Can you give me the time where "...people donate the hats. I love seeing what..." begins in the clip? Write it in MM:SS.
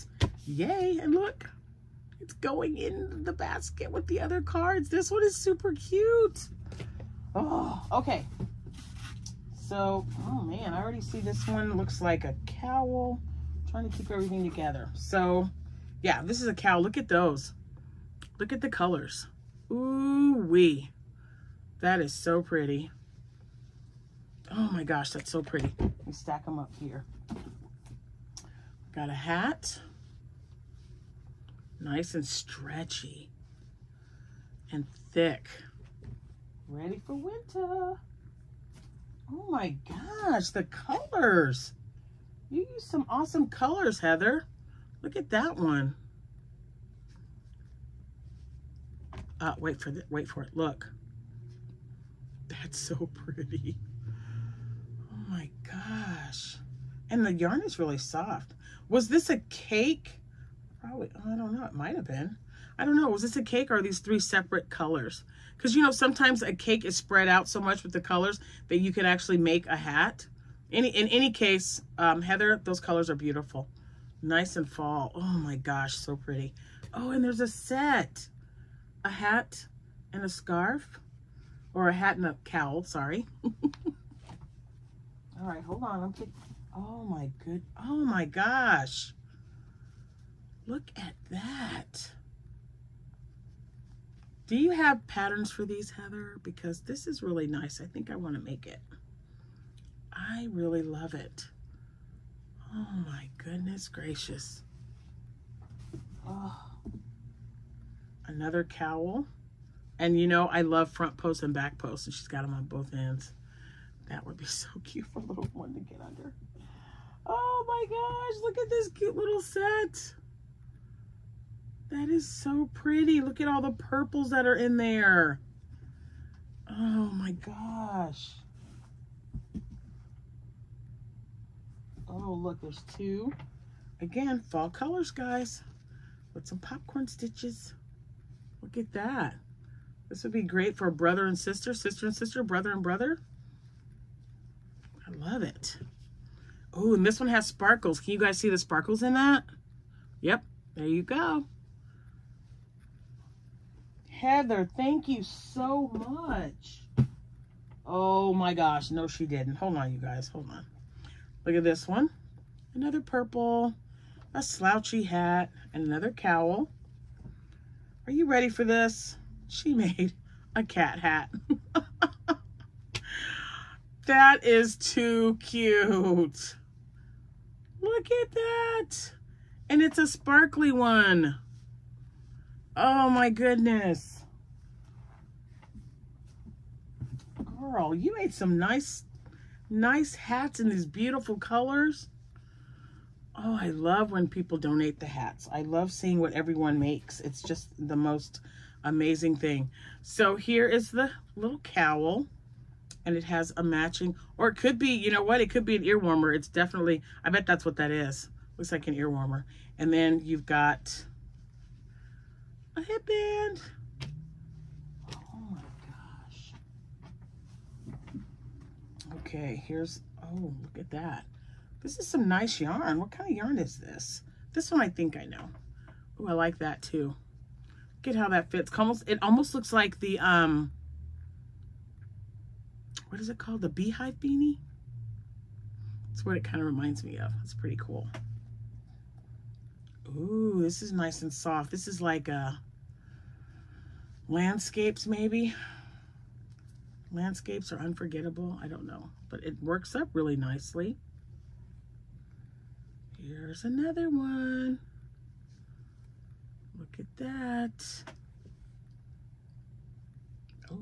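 03:14.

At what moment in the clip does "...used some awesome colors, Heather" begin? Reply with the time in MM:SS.
00:42.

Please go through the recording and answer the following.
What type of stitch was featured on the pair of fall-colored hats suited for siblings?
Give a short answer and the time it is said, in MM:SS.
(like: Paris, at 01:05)
popcorn stitches, at 02:16.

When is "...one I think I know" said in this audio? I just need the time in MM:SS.
03:44.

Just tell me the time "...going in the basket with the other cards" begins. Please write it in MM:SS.
00:02.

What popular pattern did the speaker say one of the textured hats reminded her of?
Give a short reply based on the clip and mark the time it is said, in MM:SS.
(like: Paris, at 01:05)
beehive beanie, at 03:53.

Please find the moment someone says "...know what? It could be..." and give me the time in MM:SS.
03:25.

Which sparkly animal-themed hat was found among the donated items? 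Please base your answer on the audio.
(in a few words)
cat hat.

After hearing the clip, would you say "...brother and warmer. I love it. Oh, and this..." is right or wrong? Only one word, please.
wrong.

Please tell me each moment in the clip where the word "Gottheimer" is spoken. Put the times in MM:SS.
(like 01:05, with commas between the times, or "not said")
not said.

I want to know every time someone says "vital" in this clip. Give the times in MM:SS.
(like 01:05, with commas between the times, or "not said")
not said.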